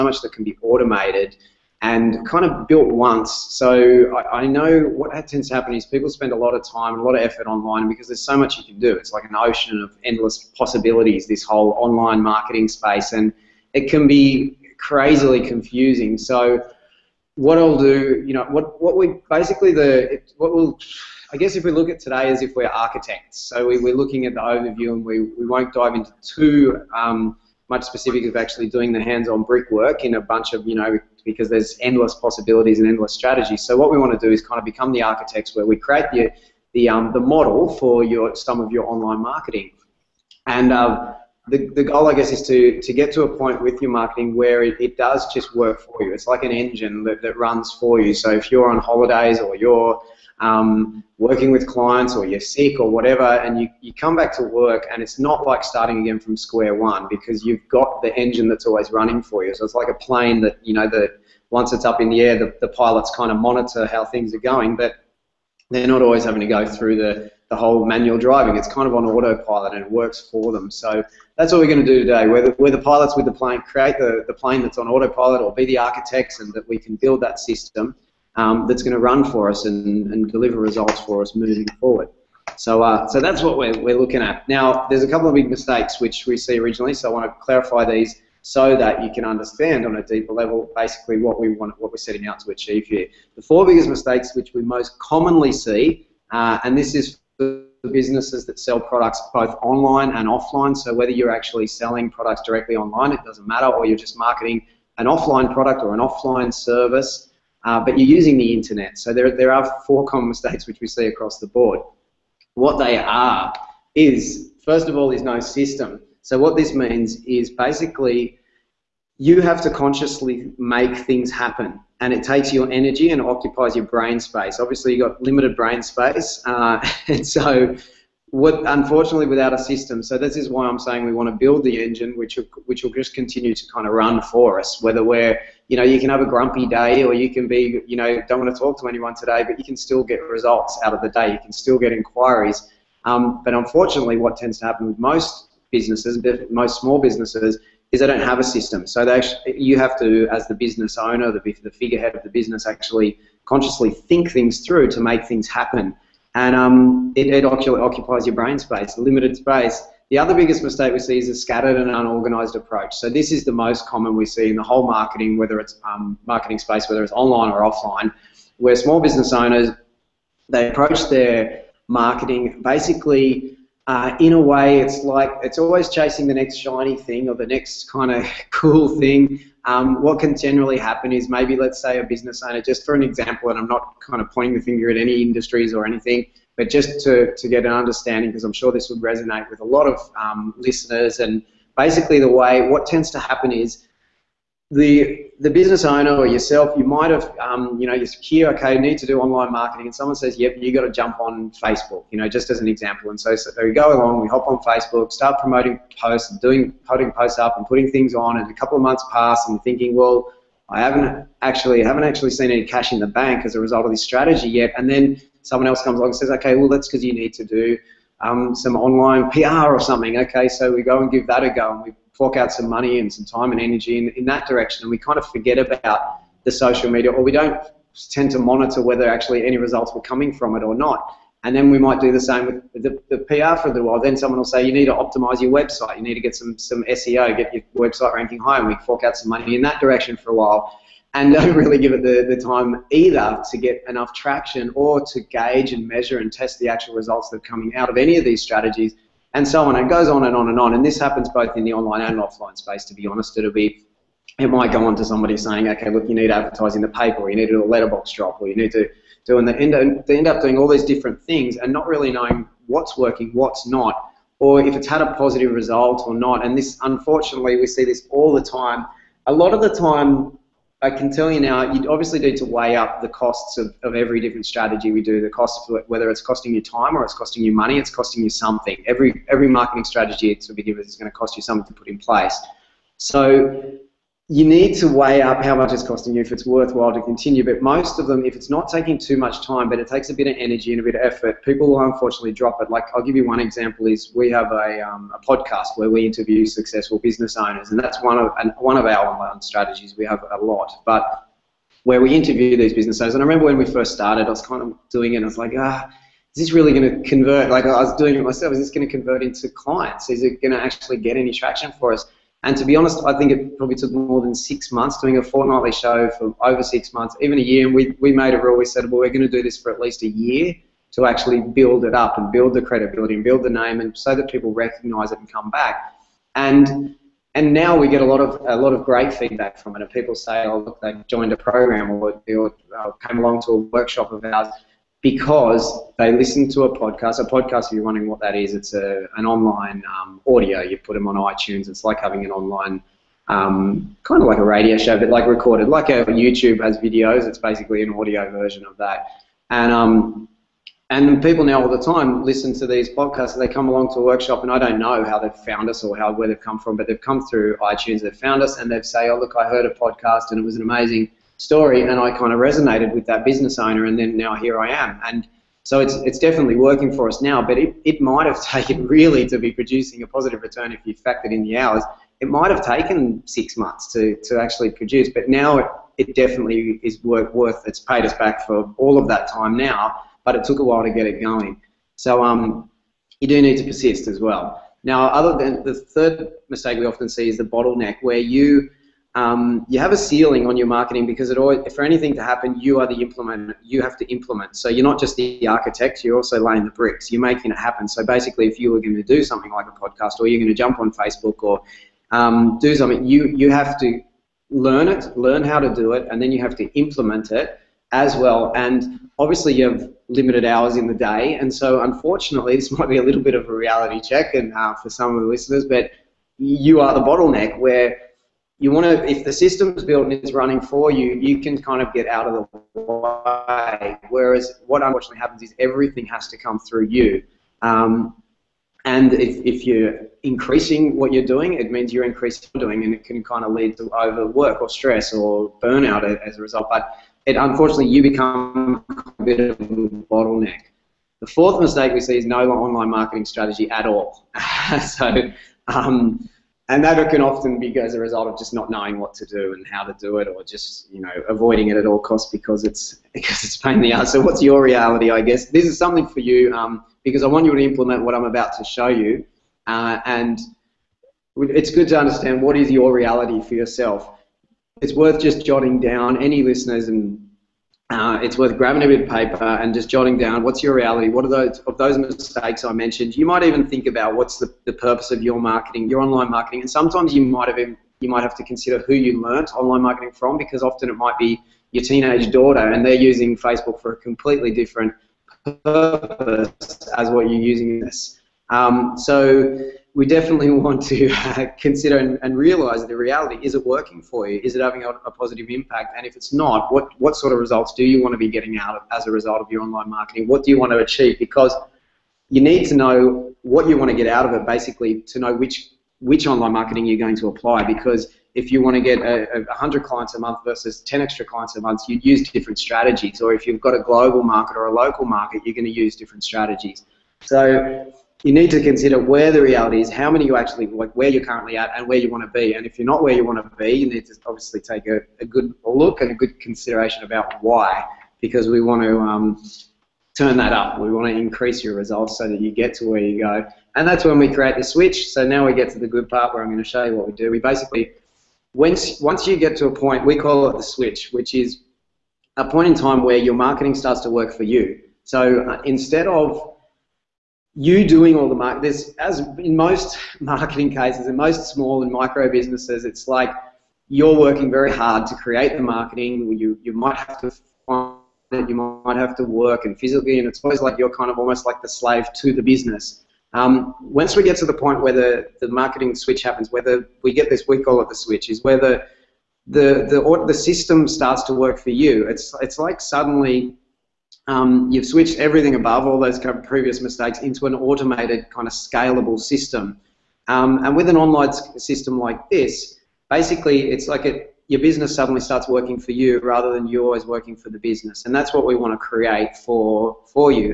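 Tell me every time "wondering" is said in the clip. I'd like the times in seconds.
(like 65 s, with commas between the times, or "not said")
337 s.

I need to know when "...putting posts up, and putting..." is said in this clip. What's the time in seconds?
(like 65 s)
206 s.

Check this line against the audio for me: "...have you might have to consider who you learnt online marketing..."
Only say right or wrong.
right.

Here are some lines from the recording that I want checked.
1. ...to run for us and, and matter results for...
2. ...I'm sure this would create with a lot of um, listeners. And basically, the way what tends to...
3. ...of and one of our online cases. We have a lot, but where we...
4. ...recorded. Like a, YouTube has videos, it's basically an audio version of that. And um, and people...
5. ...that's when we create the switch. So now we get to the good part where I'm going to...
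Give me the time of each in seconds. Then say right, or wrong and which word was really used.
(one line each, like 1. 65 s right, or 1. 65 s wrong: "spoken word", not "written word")
1. 78 s wrong: "deliver", not "matter"
2. 188 s wrong: "resonate", not "create"
3. 298 s wrong: "strategies", not "cases"
4. 345 s right
5. 533 s right.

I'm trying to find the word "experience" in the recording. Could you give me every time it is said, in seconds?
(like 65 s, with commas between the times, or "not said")
not said.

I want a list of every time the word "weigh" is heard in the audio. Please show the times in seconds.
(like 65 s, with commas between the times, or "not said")
272 s, 284 s.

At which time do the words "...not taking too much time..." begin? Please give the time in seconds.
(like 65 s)
288 s.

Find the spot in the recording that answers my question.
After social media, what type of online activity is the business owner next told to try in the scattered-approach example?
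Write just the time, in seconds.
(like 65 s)
218 s.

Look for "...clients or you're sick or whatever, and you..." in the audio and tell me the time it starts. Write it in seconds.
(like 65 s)
51 s.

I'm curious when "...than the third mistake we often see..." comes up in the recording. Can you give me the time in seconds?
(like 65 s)
385 s.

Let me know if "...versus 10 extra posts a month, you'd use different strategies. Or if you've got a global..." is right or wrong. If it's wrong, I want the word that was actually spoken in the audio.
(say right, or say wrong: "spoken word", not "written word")
wrong: "clients", not "posts".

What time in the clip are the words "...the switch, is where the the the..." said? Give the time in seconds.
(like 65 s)
567 s.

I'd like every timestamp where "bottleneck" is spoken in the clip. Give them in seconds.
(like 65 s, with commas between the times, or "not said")
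387 s, 417 s, 439 s.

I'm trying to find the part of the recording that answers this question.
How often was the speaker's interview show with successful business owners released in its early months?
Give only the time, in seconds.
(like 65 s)
315 s.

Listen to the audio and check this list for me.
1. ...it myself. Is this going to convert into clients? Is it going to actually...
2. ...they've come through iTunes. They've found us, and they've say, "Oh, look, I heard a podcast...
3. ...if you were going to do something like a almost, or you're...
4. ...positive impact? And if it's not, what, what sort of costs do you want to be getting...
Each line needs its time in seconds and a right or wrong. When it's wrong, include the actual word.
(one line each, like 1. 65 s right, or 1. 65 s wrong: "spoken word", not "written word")
1. 308 s right
2. 356 s right
3. 398 s wrong: "podcast", not "almost"
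4. 495 s wrong: "results", not "costs".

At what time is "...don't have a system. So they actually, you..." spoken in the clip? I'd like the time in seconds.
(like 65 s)
148 s.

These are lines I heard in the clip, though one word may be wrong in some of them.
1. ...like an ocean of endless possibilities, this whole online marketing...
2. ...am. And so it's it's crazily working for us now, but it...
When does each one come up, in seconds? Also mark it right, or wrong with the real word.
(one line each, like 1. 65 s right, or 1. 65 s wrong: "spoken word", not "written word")
1. 9 s right
2. 364 s wrong: "definitely", not "crazily".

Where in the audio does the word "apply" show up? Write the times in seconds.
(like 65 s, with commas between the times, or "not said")
507 s.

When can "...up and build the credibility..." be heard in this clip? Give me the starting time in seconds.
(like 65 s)
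321 s.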